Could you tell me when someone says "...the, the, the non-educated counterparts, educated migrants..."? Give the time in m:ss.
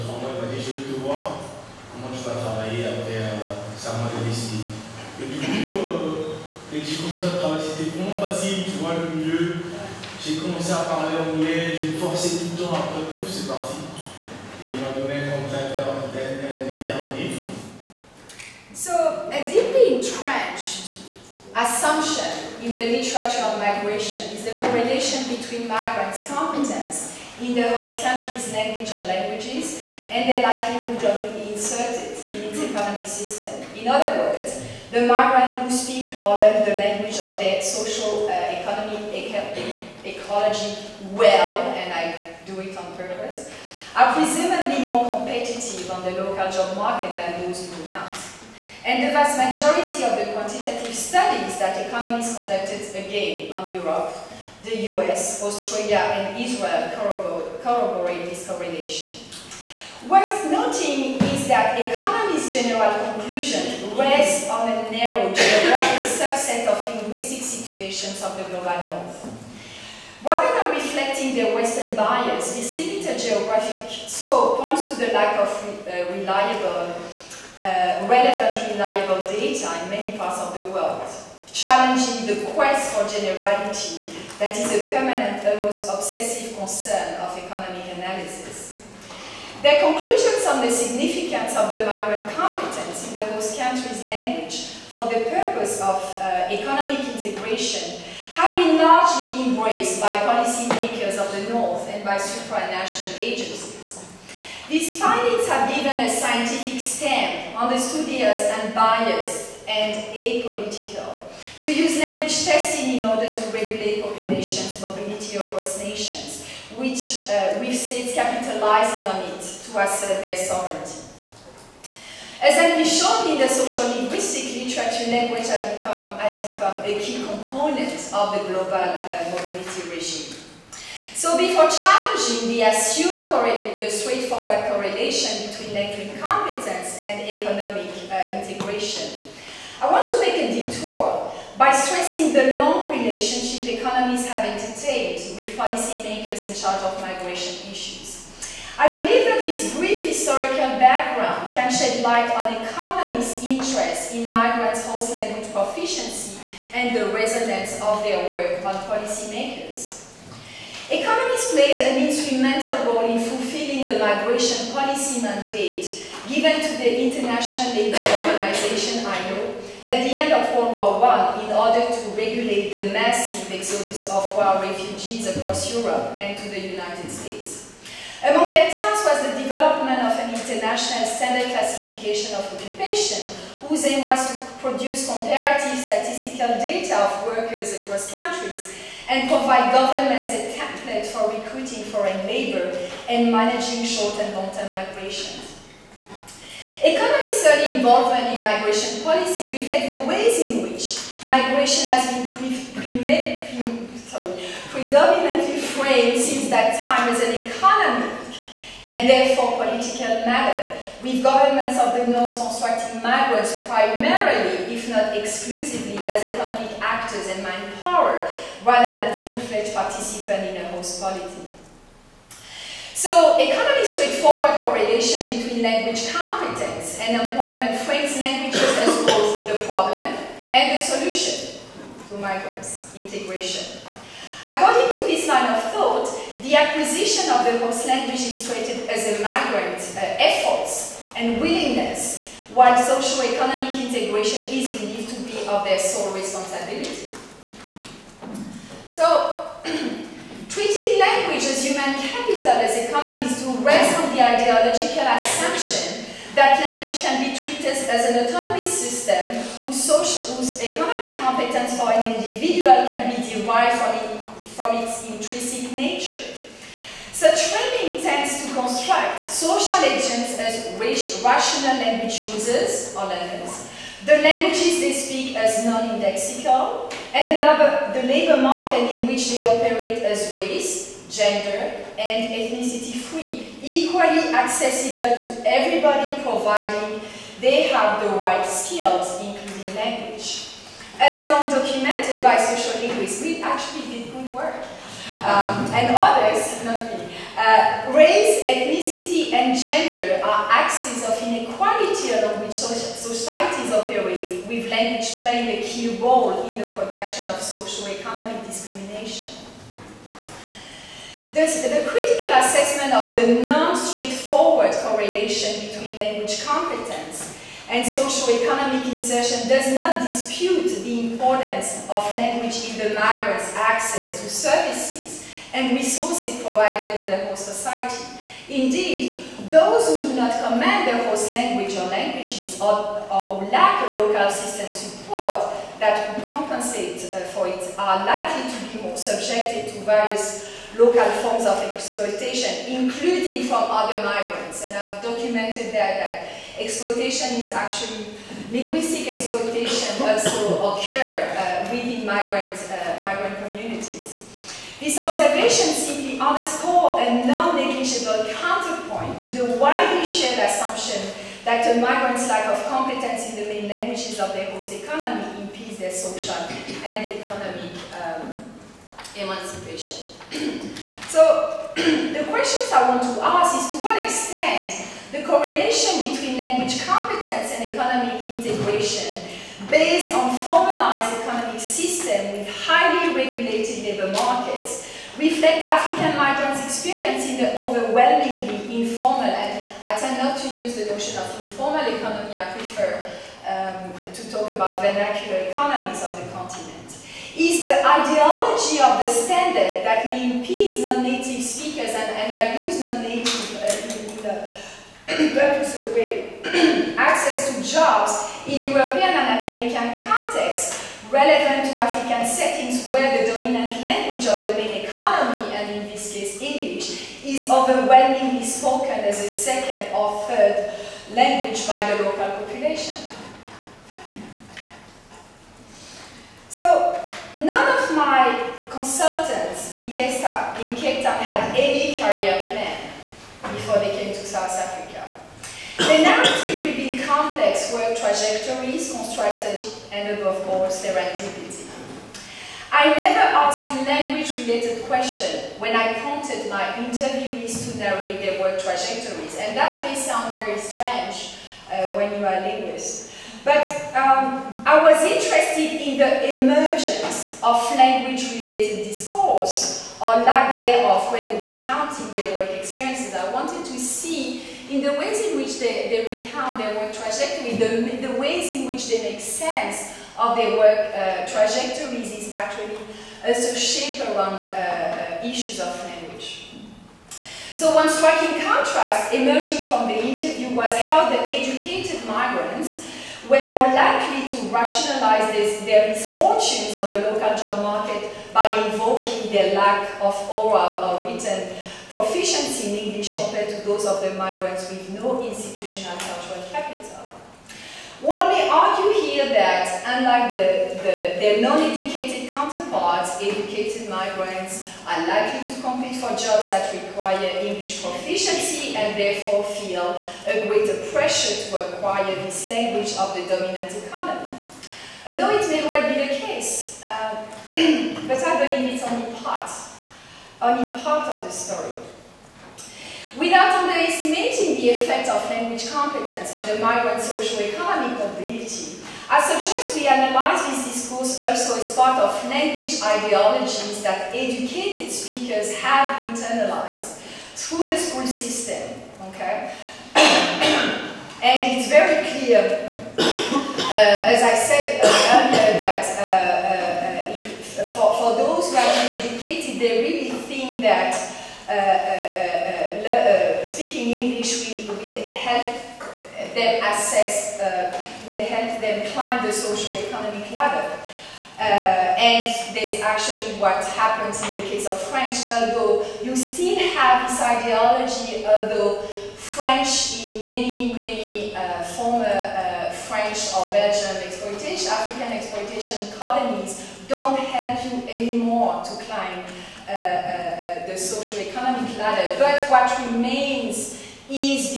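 8:20.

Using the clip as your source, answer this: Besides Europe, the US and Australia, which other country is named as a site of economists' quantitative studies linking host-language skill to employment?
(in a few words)
Israel.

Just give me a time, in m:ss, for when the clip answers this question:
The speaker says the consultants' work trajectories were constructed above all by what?
7:20.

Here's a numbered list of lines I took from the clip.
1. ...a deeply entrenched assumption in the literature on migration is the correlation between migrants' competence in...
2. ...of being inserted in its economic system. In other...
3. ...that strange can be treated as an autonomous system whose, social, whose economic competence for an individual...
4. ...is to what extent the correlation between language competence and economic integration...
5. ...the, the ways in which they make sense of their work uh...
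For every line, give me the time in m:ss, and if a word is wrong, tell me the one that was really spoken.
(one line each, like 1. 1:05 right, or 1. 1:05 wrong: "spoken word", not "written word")
1. 0:19 right
2. 0:31 right
3. 4:16 wrong: "language", not "strange"
4. 6:13 right
5. 7:47 right.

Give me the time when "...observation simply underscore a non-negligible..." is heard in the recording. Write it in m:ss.
5:54.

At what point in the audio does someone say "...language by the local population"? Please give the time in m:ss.
7:01.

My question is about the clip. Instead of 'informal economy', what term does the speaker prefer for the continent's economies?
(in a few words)
Vernacular economies.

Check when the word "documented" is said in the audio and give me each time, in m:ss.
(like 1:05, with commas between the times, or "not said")
4:51, 5:45.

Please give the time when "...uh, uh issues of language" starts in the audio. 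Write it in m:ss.
7:54.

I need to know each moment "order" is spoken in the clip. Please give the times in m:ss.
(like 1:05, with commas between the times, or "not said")
1:53, 2:51.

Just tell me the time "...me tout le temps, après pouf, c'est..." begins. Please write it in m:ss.
0:11.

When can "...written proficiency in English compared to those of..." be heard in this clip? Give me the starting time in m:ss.
8:11.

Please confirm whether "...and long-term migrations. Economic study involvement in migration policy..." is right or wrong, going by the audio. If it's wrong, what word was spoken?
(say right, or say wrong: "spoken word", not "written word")
right.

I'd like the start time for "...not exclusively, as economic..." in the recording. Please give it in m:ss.
3:34.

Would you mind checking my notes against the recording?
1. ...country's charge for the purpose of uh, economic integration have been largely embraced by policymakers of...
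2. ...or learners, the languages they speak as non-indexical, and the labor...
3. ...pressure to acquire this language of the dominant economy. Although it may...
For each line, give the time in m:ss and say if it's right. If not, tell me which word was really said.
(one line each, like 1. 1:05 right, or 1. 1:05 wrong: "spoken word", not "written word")
1. 1:33 wrong: "language", not "charge"
2. 4:32 right
3. 8:30 right.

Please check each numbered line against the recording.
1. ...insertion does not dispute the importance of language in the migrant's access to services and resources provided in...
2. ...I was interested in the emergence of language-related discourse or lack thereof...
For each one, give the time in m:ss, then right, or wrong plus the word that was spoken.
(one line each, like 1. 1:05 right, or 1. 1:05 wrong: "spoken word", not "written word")
1. 5:18 right
2. 7:34 right.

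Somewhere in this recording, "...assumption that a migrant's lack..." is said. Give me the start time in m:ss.
6:00.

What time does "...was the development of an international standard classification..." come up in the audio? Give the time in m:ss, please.
2:59.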